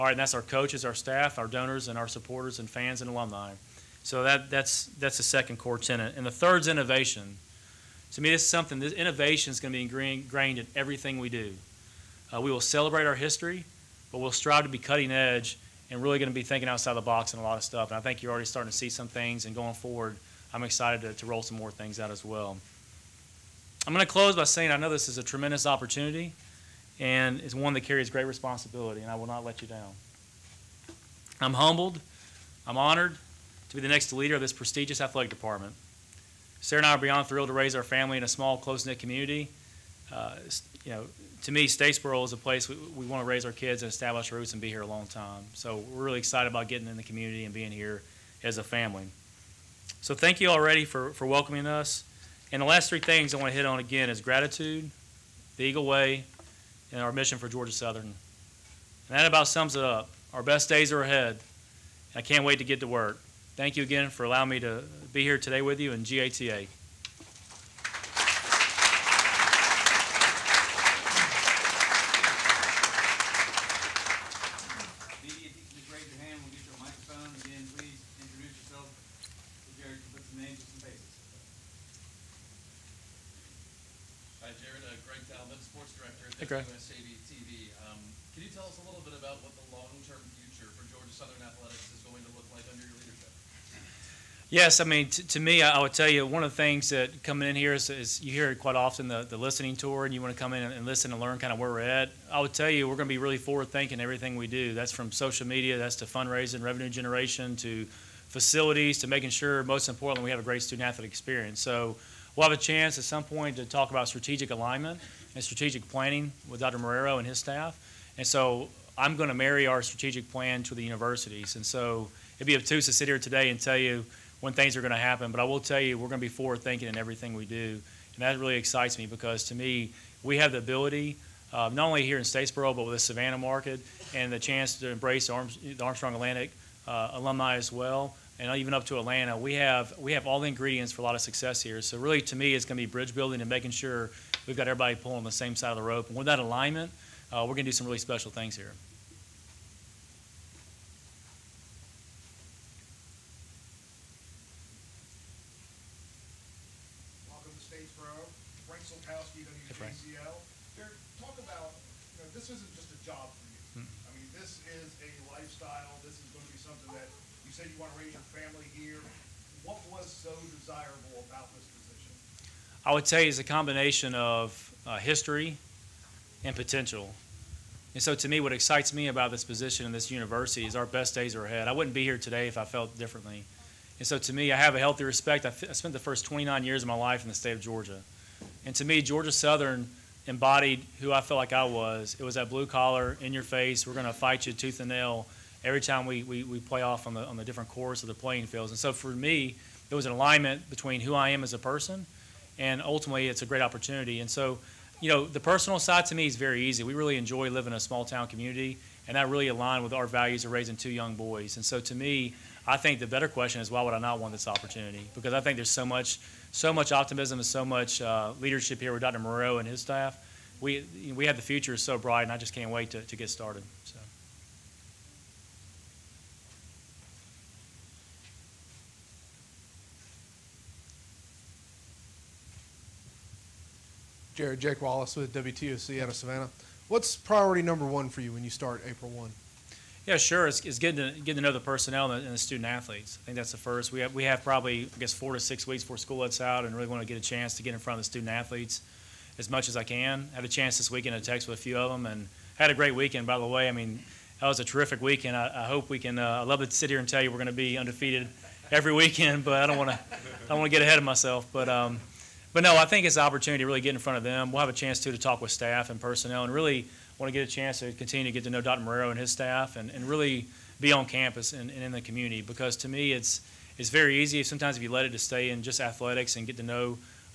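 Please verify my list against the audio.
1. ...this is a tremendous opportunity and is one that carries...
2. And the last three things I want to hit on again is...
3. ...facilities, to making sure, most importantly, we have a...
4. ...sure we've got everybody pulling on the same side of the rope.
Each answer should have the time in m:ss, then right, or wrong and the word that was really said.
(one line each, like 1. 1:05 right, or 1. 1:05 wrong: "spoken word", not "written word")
1. 0:24 right
2. 0:52 right
3. 1:48 right
4. 2:23 right.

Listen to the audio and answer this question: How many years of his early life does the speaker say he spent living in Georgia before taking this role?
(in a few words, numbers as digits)
29.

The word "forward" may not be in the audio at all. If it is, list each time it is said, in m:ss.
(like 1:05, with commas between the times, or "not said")
0:19, 1:43, 2:06.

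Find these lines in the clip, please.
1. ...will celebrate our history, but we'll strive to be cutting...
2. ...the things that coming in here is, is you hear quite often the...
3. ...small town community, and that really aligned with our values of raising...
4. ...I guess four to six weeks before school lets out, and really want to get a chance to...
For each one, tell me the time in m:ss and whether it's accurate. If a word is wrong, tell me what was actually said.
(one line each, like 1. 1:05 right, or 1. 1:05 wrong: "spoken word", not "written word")
1. 0:12 right
2. 1:36 right
3. 3:27 right
4. 4:04 right.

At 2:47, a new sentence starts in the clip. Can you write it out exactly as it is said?
you said you want to raise your family here.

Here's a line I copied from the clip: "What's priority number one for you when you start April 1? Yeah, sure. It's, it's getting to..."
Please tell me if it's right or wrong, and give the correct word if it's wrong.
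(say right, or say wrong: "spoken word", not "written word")
right.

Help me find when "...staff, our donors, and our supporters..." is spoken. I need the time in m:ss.
0:00.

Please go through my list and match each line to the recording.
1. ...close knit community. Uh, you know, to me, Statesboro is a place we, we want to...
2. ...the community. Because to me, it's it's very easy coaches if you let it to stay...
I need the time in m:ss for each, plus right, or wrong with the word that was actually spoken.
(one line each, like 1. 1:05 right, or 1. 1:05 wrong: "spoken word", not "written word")
1. 0:38 right
2. 4:31 wrong: "sometimes", not "coaches".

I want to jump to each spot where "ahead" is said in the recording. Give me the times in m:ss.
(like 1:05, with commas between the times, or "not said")
3:01, 4:20.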